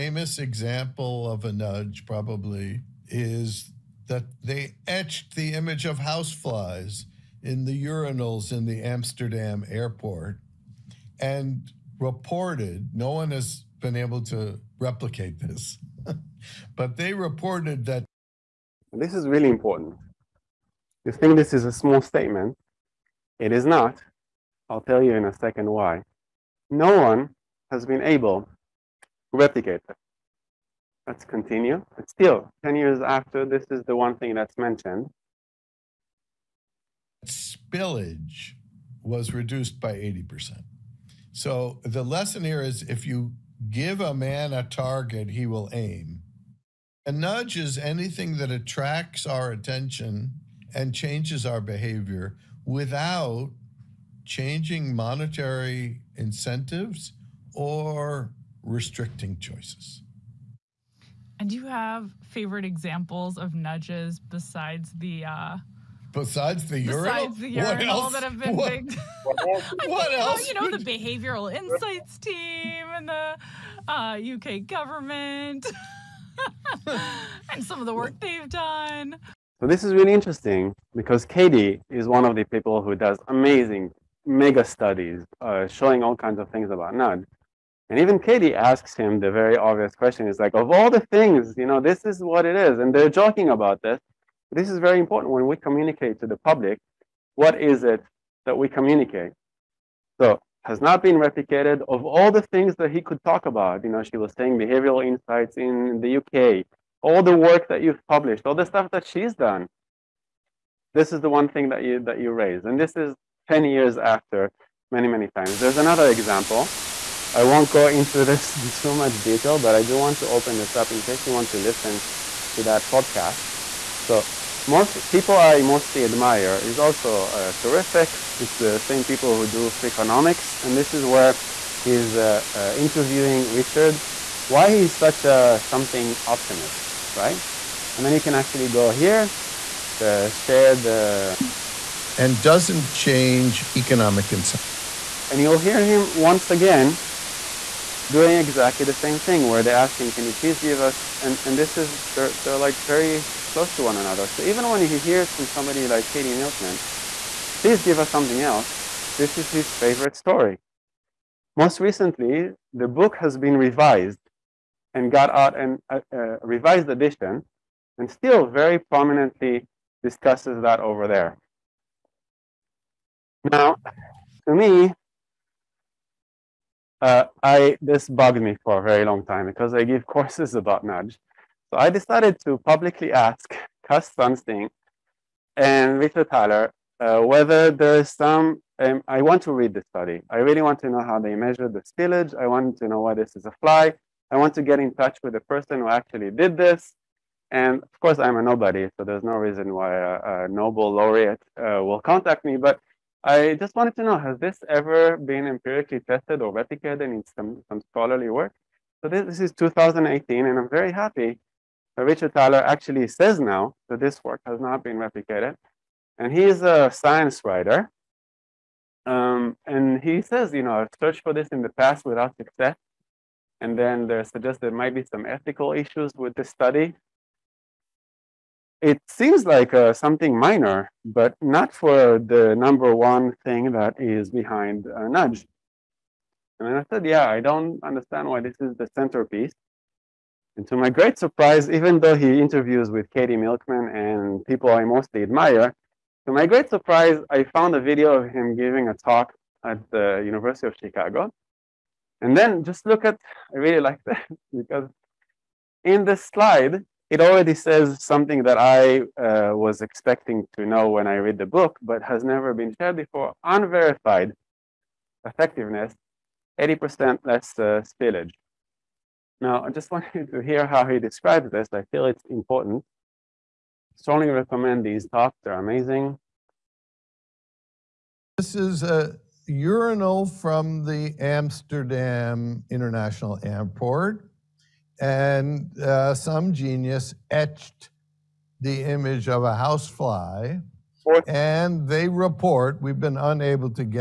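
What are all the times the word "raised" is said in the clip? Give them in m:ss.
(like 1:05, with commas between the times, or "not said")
1:52.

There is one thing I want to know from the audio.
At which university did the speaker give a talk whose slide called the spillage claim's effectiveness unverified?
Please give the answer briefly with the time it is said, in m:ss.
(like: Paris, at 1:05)
University of Chicago, at 4:10.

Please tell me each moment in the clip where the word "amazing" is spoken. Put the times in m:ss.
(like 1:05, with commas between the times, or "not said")
1:23, 4:35.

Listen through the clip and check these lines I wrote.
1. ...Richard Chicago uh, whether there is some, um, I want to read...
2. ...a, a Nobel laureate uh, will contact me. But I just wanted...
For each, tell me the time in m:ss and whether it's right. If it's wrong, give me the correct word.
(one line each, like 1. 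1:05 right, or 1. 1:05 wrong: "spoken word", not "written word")
1. 3:05 wrong: "Thaler", not "Chicago"
2. 3:19 right.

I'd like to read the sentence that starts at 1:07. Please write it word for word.
the urinal that have been what, big.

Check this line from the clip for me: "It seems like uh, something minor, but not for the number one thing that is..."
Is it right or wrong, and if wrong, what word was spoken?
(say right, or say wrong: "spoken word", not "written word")
right.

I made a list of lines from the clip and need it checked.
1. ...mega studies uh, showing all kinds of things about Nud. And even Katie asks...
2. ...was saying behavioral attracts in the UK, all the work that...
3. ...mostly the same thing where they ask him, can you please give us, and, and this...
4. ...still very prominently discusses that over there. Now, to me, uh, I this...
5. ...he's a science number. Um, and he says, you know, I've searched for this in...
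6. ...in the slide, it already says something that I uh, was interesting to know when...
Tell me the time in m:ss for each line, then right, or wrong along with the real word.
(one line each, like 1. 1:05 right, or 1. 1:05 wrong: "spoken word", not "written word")
1. 1:24 right
2. 1:44 wrong: "insights", not "attracts"
3. 2:28 wrong: "exactly", not "mostly"
4. 2:48 right
5. 3:36 wrong: "writer", not "number"
6. 4:15 wrong: "expecting", not "interesting".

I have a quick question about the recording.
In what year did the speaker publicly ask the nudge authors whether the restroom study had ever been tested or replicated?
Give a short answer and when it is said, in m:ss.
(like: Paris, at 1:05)
2018, at 3:29.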